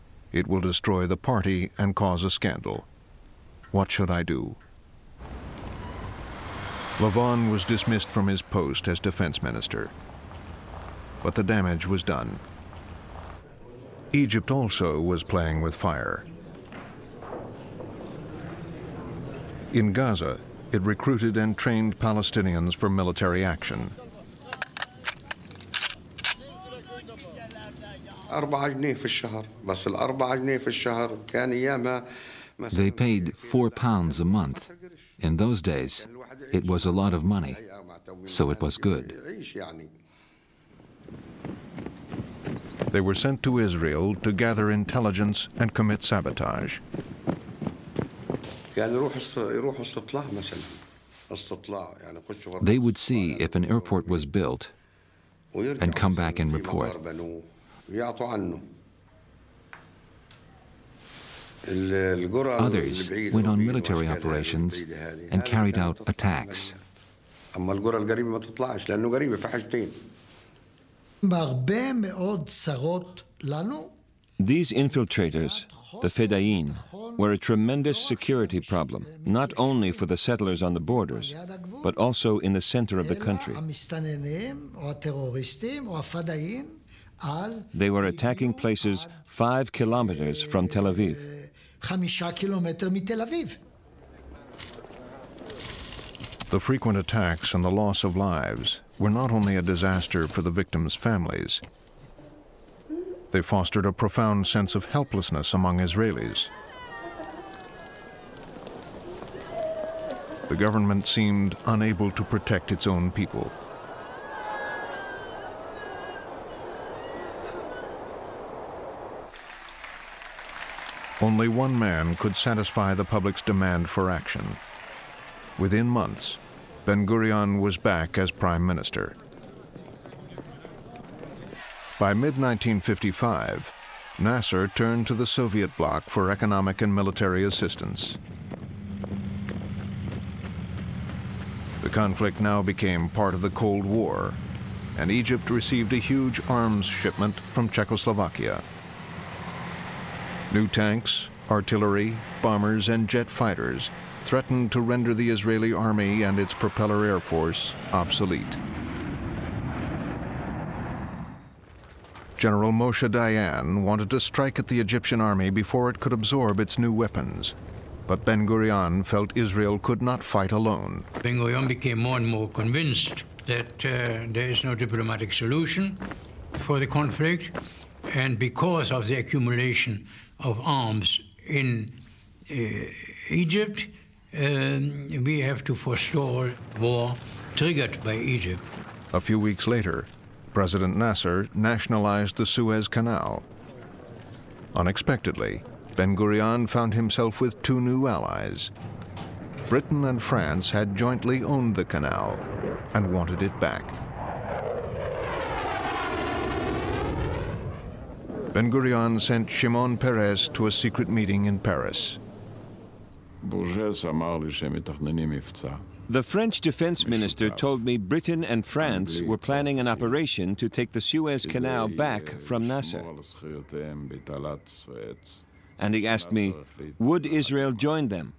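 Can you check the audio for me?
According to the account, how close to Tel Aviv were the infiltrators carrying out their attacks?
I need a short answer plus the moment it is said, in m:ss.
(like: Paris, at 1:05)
5 kilometers, at 1:29.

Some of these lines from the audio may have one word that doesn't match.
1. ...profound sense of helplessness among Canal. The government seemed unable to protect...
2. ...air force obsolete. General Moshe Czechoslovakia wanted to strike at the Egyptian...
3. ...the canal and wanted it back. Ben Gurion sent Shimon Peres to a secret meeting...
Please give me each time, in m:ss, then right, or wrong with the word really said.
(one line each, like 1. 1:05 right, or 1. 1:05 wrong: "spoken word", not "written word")
1. 1:43 wrong: "Israelis", not "Canal"
2. 2:37 wrong: "Dayan", not "Czechoslovakia"
3. 3:21 right.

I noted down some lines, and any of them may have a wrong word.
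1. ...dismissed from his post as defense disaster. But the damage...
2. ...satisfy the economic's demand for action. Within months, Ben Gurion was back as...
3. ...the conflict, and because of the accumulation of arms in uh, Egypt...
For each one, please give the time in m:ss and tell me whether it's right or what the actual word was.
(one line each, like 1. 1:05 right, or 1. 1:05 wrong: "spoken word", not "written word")
1. 0:07 wrong: "minister", not "disaster"
2. 2:02 wrong: "public", not "economic"
3. 2:56 right.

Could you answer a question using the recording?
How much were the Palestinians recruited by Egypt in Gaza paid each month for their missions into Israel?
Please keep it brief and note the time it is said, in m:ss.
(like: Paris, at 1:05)
4 pounds, at 0:33.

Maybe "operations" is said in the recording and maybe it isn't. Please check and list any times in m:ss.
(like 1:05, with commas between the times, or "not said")
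1:04, 3:39.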